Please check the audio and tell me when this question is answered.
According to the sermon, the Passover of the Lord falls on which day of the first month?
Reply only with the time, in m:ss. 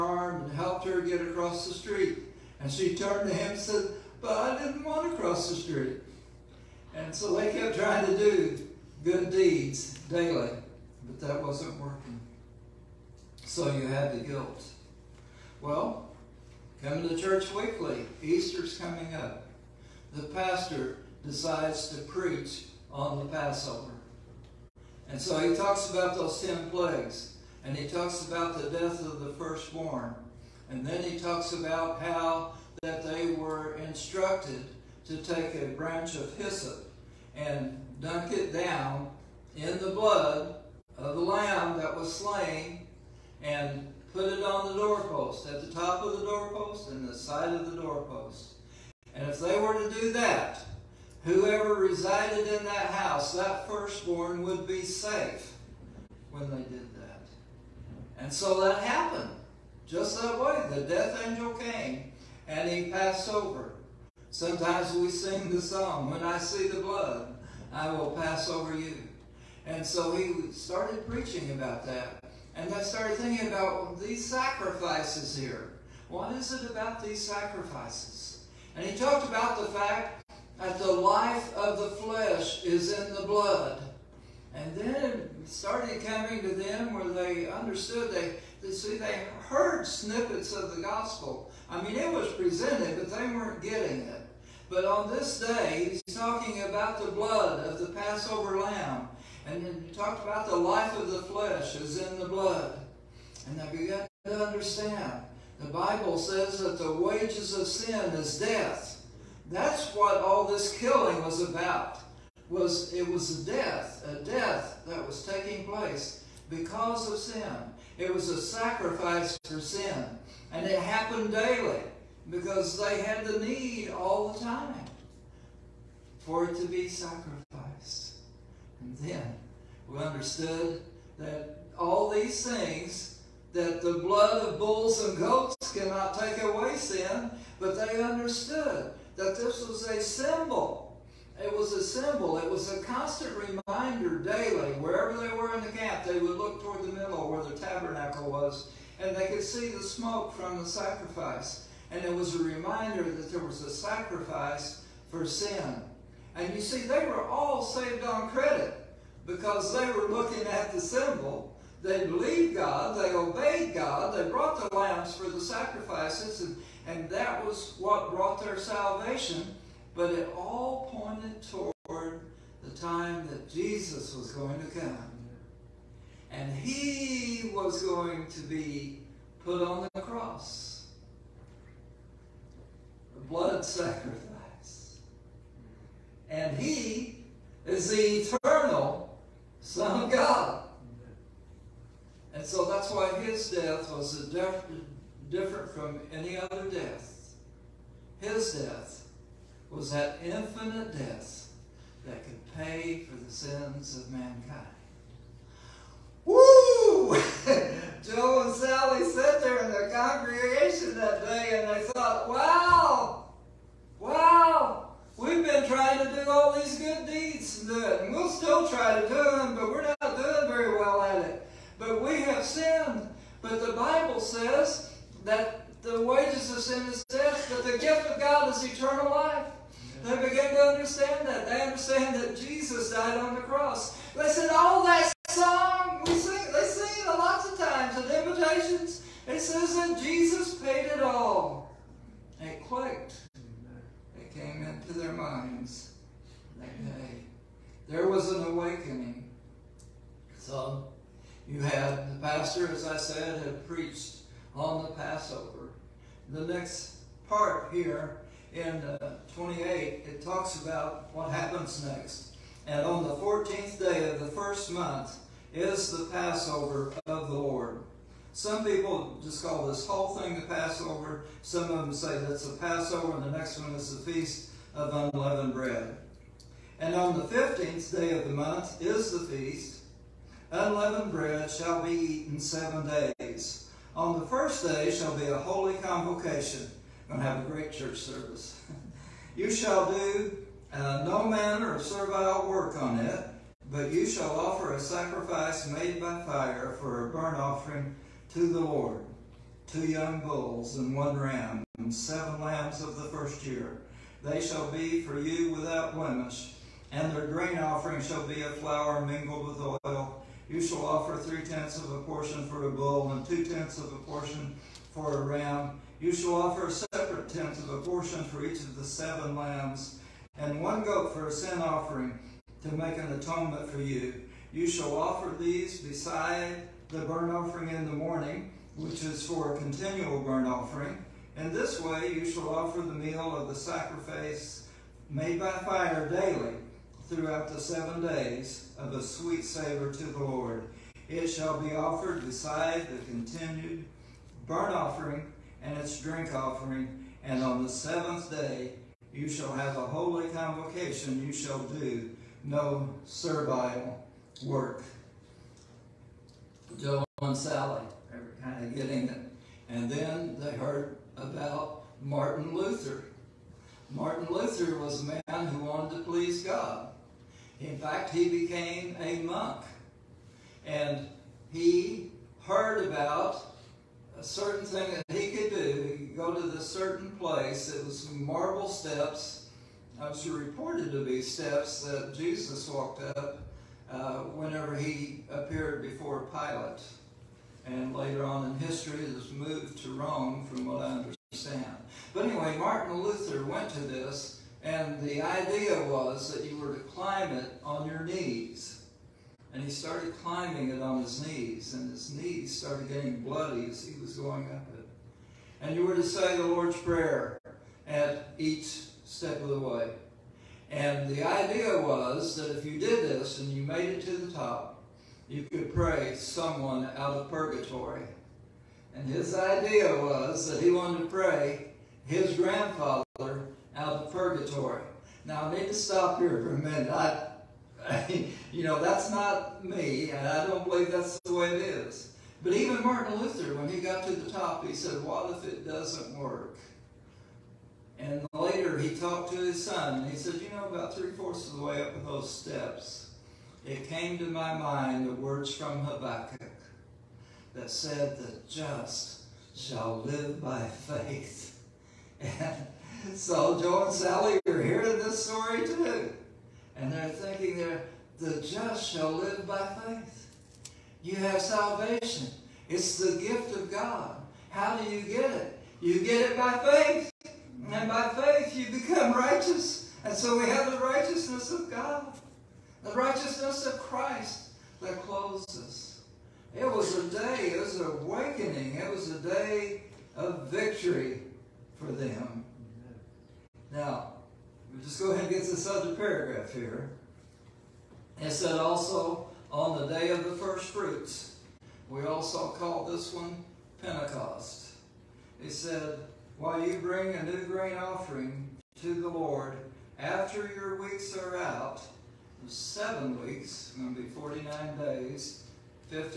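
4:23.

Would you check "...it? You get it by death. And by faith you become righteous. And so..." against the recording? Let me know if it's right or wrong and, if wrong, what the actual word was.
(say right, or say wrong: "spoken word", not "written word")
wrong: "faith", not "death".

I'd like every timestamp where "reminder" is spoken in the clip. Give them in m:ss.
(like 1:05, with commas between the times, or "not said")
2:23, 2:32.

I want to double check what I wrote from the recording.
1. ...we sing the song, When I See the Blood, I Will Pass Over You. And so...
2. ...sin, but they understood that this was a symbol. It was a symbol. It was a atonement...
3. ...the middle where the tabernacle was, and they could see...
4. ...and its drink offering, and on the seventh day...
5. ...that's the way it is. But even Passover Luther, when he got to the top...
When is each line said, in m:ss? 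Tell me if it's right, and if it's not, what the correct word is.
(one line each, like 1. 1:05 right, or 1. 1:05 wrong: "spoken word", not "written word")
1. 1:04 right
2. 2:16 wrong: "constant", not "atonement"
3. 2:26 right
4. 5:45 right
5. 7:10 wrong: "Martin", not "Passover".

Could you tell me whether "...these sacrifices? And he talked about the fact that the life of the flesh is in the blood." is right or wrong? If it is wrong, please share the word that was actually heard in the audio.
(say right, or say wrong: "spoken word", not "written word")
right.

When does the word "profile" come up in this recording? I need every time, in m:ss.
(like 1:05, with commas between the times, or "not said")
not said.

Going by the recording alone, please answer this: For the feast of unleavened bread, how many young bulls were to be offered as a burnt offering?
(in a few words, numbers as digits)
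2.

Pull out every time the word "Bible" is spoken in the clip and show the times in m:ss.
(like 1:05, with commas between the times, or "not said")
1:45, 3:43.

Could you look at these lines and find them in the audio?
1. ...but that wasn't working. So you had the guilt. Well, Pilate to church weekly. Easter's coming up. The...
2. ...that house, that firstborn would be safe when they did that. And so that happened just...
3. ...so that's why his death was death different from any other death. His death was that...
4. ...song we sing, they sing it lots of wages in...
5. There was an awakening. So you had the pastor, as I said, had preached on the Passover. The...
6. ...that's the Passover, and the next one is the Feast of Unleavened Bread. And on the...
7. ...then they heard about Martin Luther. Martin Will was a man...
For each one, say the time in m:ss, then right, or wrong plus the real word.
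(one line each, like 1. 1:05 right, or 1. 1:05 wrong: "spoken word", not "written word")
1. 0:11 wrong: "Coming", not "Pilate"
2. 0:52 right
3. 3:12 right
4. 3:55 wrong: "times", not "wages"
5. 4:07 right
6. 4:32 right
7. 5:59 wrong: "Luther", not "Will".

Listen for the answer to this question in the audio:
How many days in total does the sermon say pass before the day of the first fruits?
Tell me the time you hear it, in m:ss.
8:24.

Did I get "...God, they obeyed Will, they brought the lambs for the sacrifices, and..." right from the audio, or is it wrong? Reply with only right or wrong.
wrong.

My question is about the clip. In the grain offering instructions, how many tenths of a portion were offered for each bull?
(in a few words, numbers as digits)
3.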